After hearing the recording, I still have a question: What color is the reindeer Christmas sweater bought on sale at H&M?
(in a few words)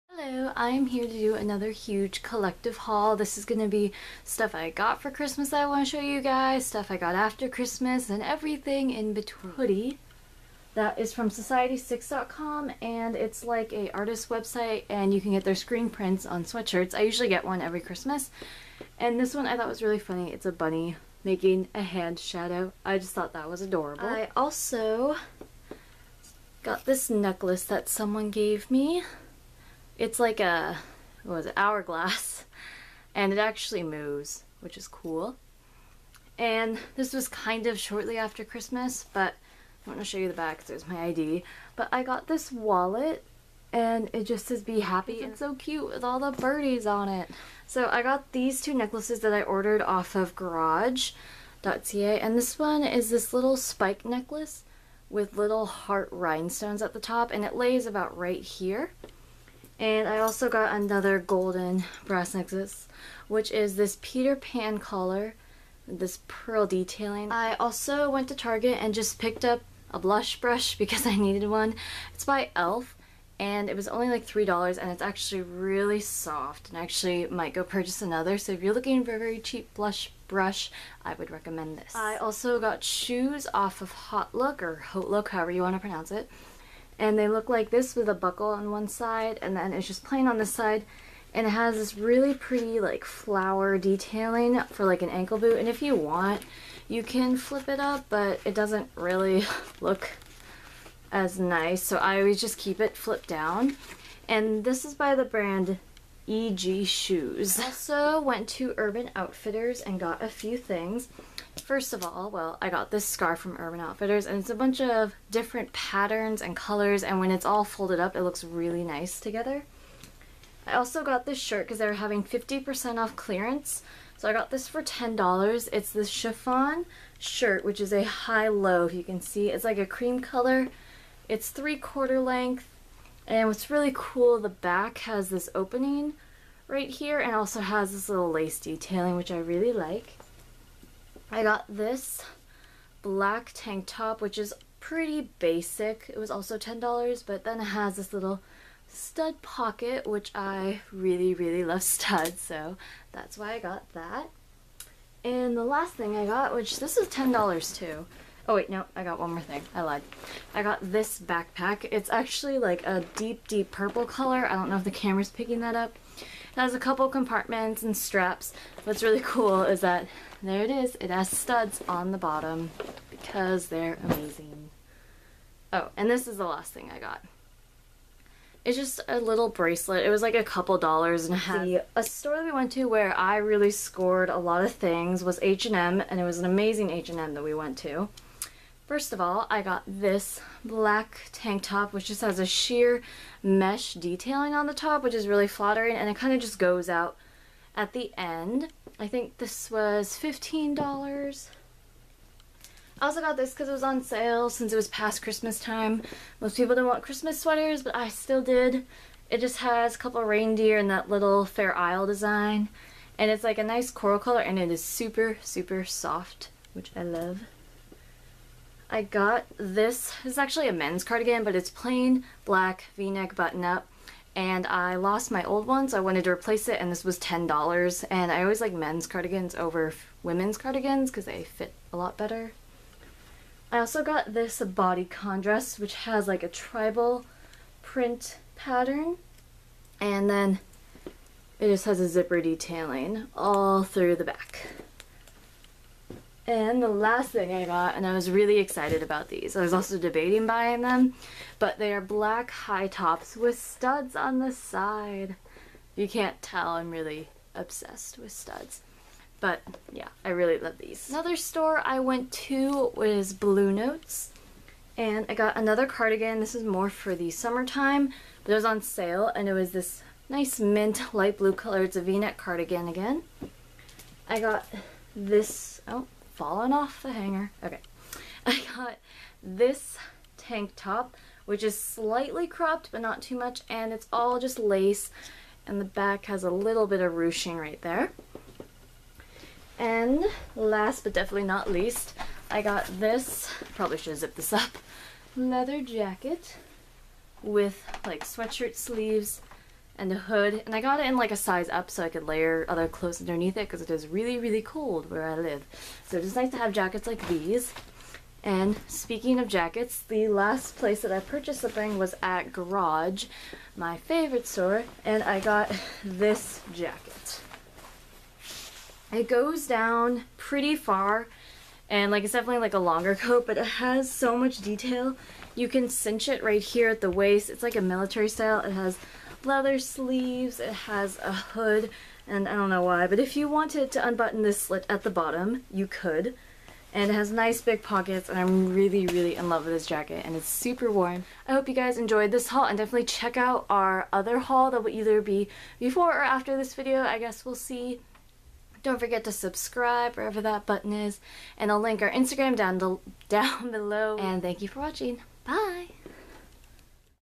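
coral.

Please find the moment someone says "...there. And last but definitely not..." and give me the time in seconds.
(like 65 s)
287 s.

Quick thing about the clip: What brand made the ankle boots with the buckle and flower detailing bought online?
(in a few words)
EG Shoes.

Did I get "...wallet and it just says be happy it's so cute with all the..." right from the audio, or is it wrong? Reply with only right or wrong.
right.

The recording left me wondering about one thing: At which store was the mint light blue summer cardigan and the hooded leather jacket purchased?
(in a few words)
Bluenotes.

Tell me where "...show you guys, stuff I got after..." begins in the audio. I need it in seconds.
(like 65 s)
5 s.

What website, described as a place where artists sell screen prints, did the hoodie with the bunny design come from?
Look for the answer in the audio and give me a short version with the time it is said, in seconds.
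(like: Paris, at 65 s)
society6.com, at 11 s.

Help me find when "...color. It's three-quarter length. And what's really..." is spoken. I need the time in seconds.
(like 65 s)
130 s.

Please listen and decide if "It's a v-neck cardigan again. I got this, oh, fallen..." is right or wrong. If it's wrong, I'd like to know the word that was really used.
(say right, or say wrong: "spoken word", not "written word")
right.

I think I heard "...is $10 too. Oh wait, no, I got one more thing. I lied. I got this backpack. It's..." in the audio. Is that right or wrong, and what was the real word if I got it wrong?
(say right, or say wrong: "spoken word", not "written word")
right.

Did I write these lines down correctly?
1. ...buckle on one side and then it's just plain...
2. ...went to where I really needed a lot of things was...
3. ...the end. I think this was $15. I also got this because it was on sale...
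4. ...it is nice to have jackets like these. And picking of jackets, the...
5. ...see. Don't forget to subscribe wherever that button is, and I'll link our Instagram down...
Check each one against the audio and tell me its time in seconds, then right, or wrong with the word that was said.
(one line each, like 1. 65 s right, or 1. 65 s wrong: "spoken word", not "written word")
1. 88 s right
2. 182 s wrong: "scored", not "needed"
3. 197 s right
4. 306 s wrong: "speaking", not "picking"
5. 347 s right.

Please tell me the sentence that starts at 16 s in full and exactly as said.
I usually get one every Christmas.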